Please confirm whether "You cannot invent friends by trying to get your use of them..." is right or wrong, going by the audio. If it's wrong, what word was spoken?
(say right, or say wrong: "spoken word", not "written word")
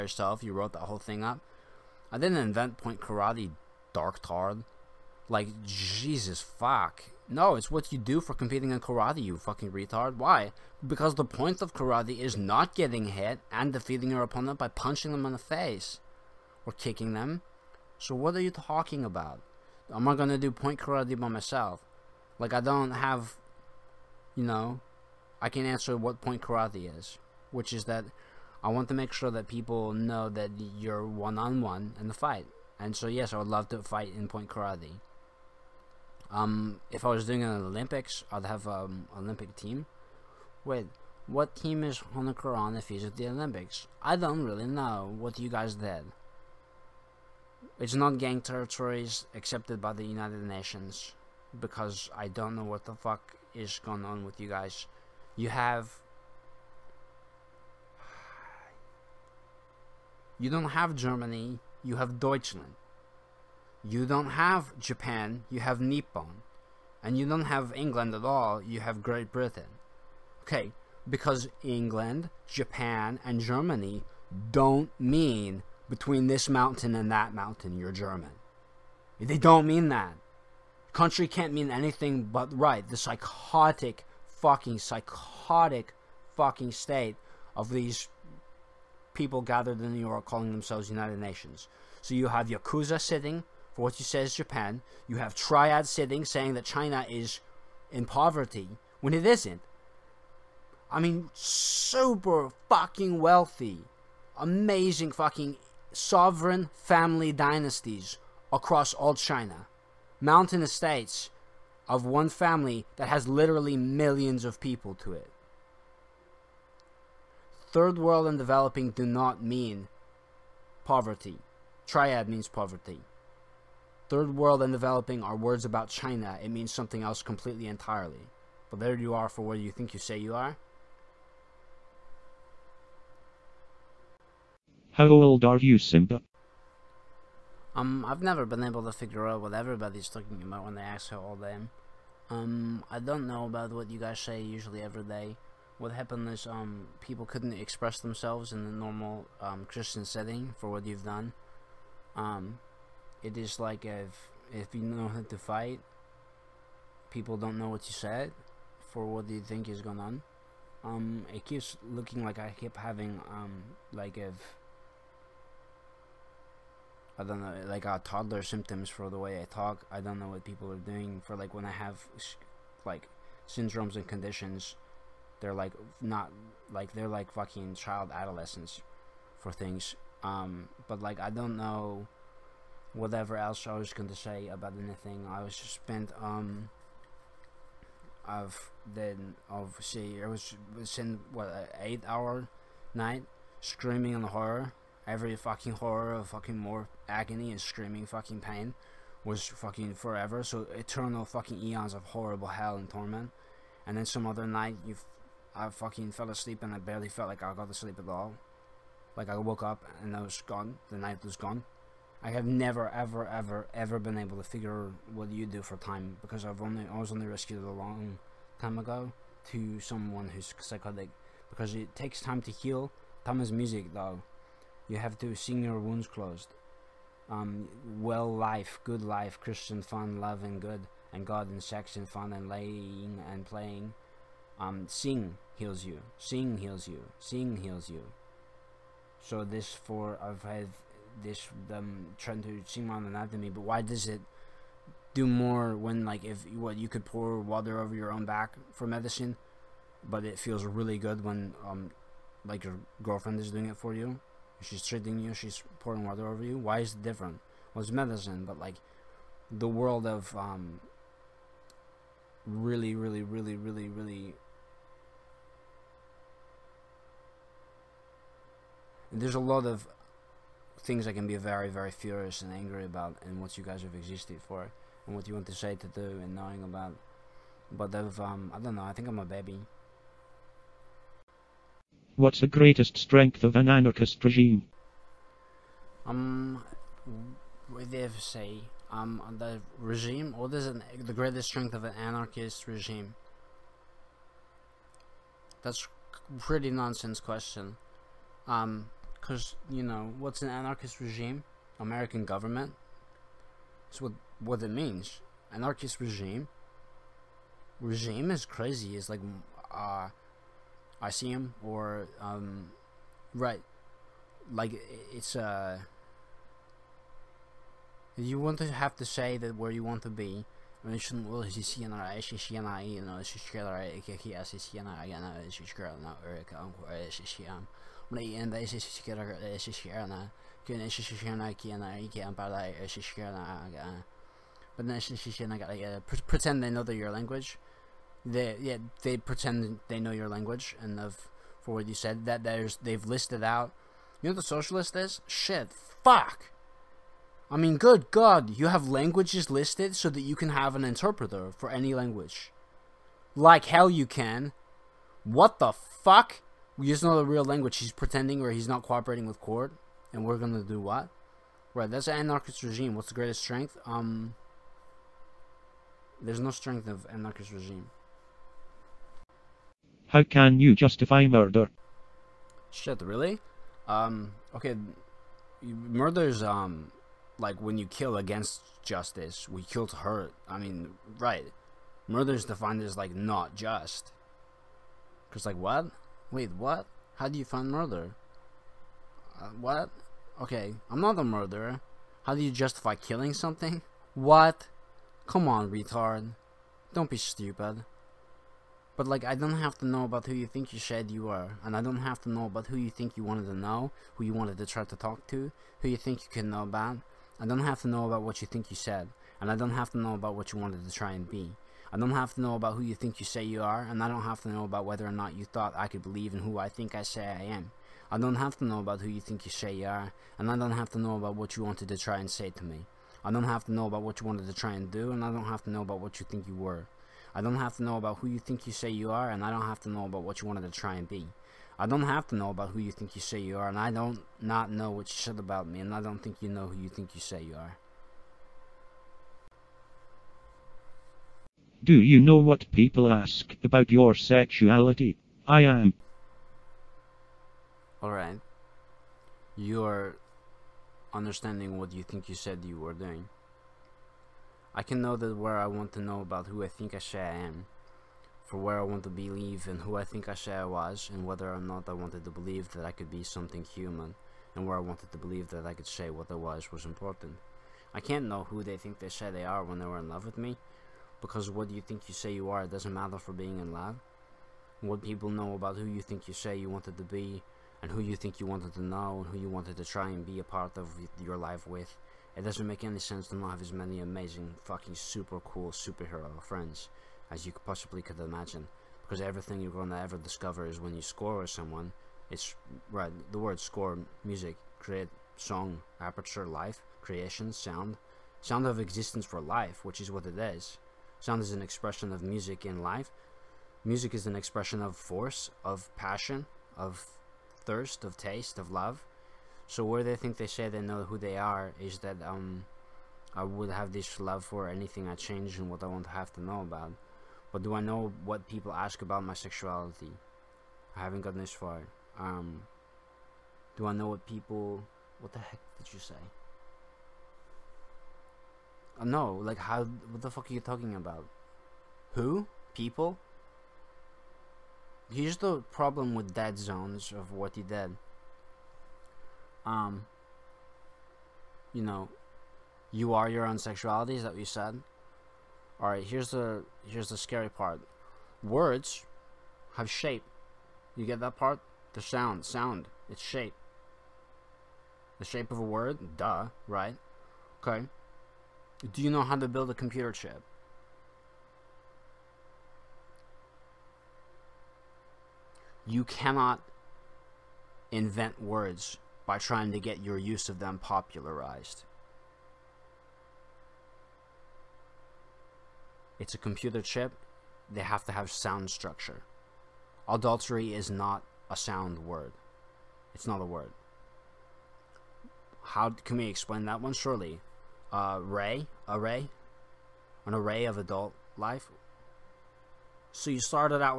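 wrong: "words", not "friends".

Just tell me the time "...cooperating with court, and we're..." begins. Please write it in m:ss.
5:58.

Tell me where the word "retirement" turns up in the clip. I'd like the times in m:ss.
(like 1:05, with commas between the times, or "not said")
not said.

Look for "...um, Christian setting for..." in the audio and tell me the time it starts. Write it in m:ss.
2:29.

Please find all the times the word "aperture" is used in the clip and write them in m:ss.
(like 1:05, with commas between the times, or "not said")
8:15.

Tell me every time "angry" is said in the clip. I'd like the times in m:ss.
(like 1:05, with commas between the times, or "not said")
4:32.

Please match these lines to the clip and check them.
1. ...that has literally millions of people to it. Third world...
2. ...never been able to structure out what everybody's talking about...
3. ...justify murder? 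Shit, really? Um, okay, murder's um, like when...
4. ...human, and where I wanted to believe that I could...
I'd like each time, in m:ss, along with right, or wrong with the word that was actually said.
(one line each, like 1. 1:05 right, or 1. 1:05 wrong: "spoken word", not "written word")
1. 1:52 right
2. 2:18 wrong: "figure", not "structure"
3. 6:10 right
4. 7:43 right.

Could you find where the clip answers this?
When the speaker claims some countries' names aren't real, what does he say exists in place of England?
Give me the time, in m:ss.
1:09.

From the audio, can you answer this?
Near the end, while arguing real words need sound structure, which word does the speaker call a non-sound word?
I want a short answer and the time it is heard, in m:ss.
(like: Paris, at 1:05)
Adultery, at 9:40.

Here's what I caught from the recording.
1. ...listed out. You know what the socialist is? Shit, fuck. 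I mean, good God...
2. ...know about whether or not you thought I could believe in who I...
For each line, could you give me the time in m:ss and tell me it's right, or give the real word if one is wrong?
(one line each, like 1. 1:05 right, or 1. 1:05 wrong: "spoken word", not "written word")
1. 5:43 right
2. 6:54 right.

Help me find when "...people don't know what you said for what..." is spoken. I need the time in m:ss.
2:37.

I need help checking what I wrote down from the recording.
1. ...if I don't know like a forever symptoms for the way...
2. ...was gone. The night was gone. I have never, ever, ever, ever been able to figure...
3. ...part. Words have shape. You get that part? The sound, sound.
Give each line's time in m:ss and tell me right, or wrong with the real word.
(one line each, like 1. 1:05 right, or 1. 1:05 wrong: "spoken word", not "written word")
1. 2:44 wrong: "toddler", not "forever"
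2. 3:30 right
3. 9:07 right.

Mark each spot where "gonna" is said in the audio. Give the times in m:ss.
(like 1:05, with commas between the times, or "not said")
0:20, 6:00.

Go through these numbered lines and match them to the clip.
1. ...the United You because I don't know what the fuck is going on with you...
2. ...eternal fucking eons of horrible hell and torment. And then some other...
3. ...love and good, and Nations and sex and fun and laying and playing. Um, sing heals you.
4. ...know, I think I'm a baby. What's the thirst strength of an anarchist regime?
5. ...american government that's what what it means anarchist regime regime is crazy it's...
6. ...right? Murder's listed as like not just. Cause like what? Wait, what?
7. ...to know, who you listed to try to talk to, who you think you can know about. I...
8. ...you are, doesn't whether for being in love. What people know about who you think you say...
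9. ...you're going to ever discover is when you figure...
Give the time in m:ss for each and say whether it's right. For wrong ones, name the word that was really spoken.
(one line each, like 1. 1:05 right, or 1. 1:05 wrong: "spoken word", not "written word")
1. 0:49 wrong: "Nations", not "You"
2. 3:20 right
3. 3:50 wrong: "God", not "Nations"
4. 4:38 wrong: "greatest", not "thirst"
5. 5:01 right
6. 6:21 wrong: "defined", not "listed"
7. 6:43 wrong: "wanted", not "listed"
8. 7:52 wrong: "matter", not "whether"
9. 8:09 wrong: "score", not "figure".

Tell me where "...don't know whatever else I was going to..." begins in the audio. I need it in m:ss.
3:01.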